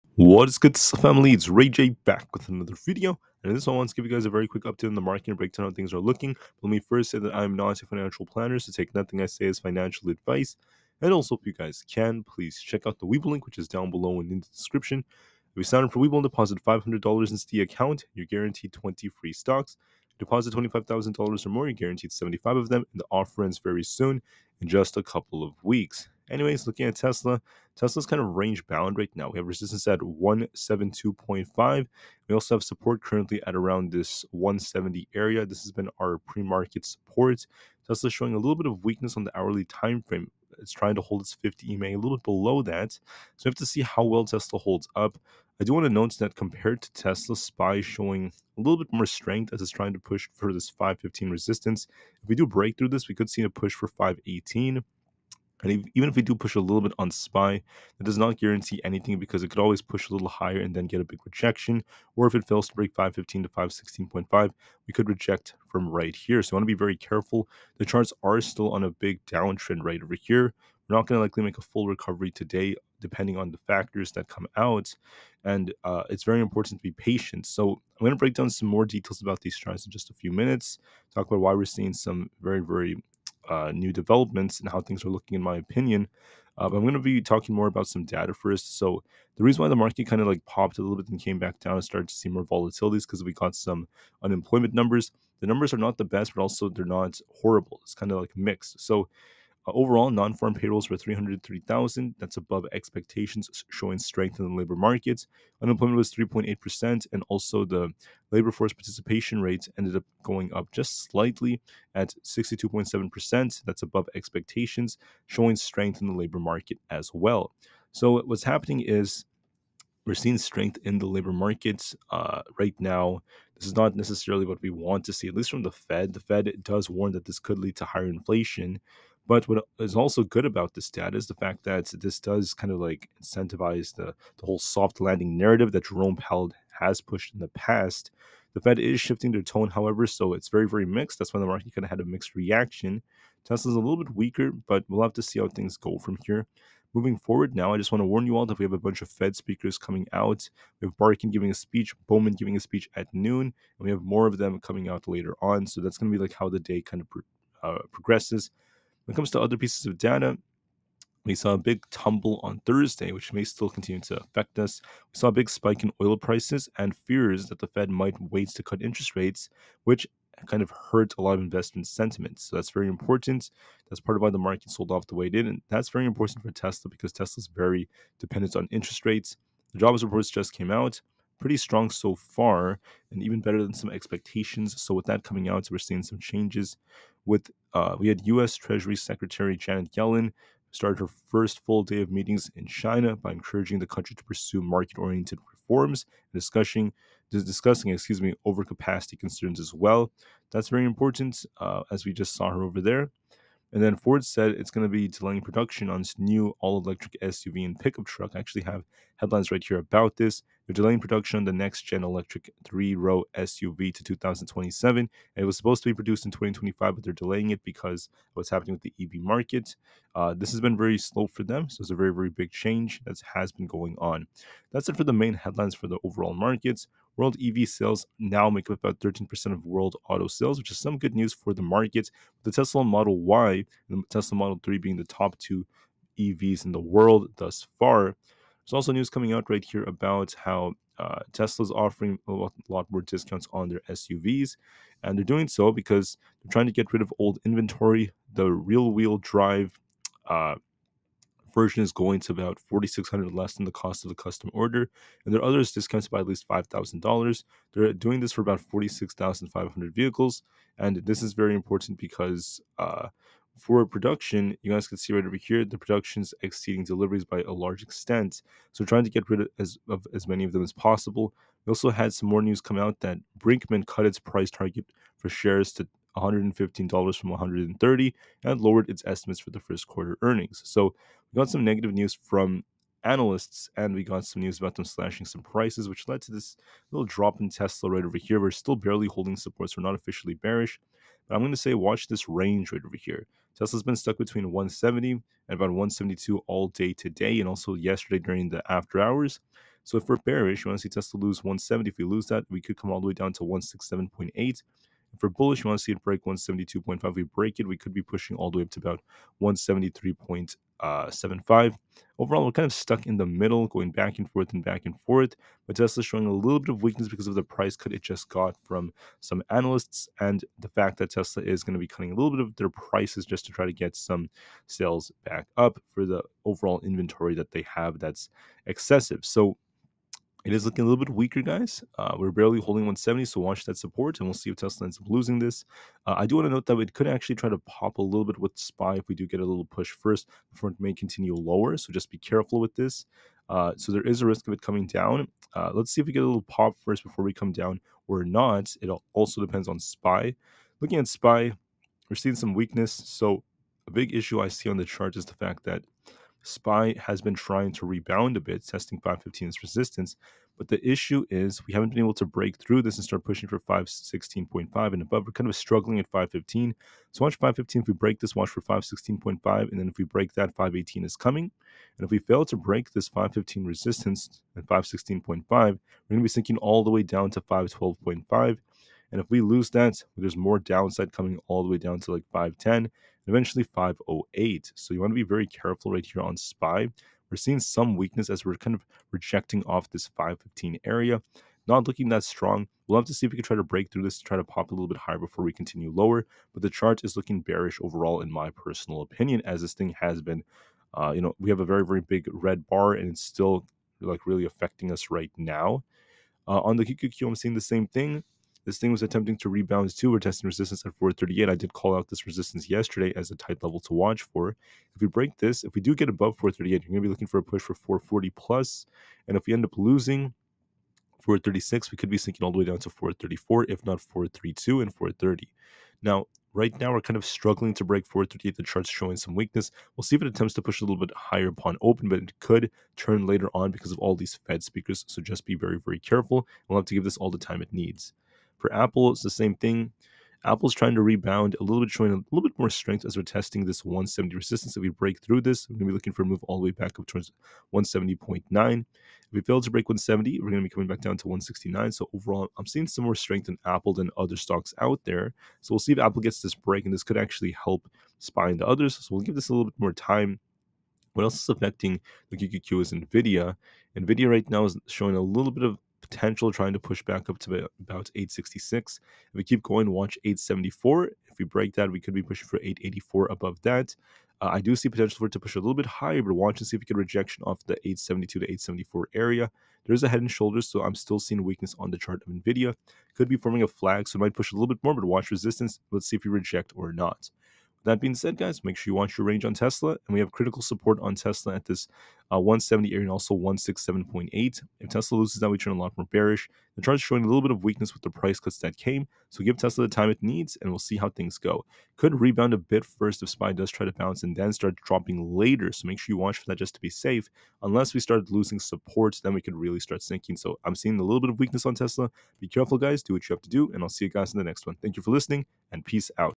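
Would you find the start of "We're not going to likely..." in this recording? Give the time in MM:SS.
01:10.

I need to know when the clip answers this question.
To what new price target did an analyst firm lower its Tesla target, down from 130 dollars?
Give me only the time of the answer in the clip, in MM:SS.
04:36.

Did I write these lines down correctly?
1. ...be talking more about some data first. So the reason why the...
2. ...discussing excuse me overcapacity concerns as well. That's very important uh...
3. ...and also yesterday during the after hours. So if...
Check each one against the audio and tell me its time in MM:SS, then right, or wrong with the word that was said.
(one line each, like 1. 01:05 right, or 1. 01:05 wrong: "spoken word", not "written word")
1. 01:26 right
2. 03:17 right
3. 04:57 right.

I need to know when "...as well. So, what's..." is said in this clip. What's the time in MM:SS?
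01:56.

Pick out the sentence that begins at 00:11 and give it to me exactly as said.
And also, if you guys can, please check out the Webull link, which is down below and in the description.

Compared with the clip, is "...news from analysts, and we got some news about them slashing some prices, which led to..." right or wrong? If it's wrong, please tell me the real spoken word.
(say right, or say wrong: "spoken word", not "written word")
right.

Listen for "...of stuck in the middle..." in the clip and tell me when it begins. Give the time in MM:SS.
05:12.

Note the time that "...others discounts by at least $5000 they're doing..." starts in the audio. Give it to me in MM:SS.
04:15.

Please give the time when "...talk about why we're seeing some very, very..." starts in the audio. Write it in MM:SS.
01:21.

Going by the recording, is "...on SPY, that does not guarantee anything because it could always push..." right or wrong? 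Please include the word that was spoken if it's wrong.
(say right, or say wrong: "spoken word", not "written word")
right.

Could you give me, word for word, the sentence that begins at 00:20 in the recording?
Deposit $25,000 or more, you're guaranteed 75 of them.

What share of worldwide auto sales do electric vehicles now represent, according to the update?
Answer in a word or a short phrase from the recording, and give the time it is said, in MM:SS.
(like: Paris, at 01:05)
13%, at 03:49.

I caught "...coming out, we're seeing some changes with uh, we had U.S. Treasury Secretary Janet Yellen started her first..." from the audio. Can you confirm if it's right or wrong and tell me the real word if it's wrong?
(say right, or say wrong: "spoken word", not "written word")
right.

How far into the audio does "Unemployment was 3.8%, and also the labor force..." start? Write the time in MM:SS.
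01:45.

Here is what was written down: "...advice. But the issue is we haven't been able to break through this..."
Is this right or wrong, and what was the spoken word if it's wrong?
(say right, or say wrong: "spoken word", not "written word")
wrong: "resistance", not "advice".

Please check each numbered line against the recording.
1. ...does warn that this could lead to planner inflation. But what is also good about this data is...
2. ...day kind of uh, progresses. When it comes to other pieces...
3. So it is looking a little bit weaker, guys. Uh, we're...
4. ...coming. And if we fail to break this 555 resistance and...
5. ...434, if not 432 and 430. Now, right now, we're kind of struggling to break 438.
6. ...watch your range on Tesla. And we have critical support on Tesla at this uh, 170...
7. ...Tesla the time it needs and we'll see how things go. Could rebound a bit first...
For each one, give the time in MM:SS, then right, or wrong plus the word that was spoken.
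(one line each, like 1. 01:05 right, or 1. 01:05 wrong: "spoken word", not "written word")
1. 02:06 wrong: "higher", not "planner"
2. 02:36 right
3. 05:29 right
4. 06:11 wrong: "515", not "555"
5. 07:02 right
6. 08:08 right
7. 08:19 right.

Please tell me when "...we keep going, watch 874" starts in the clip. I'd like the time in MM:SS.
07:49.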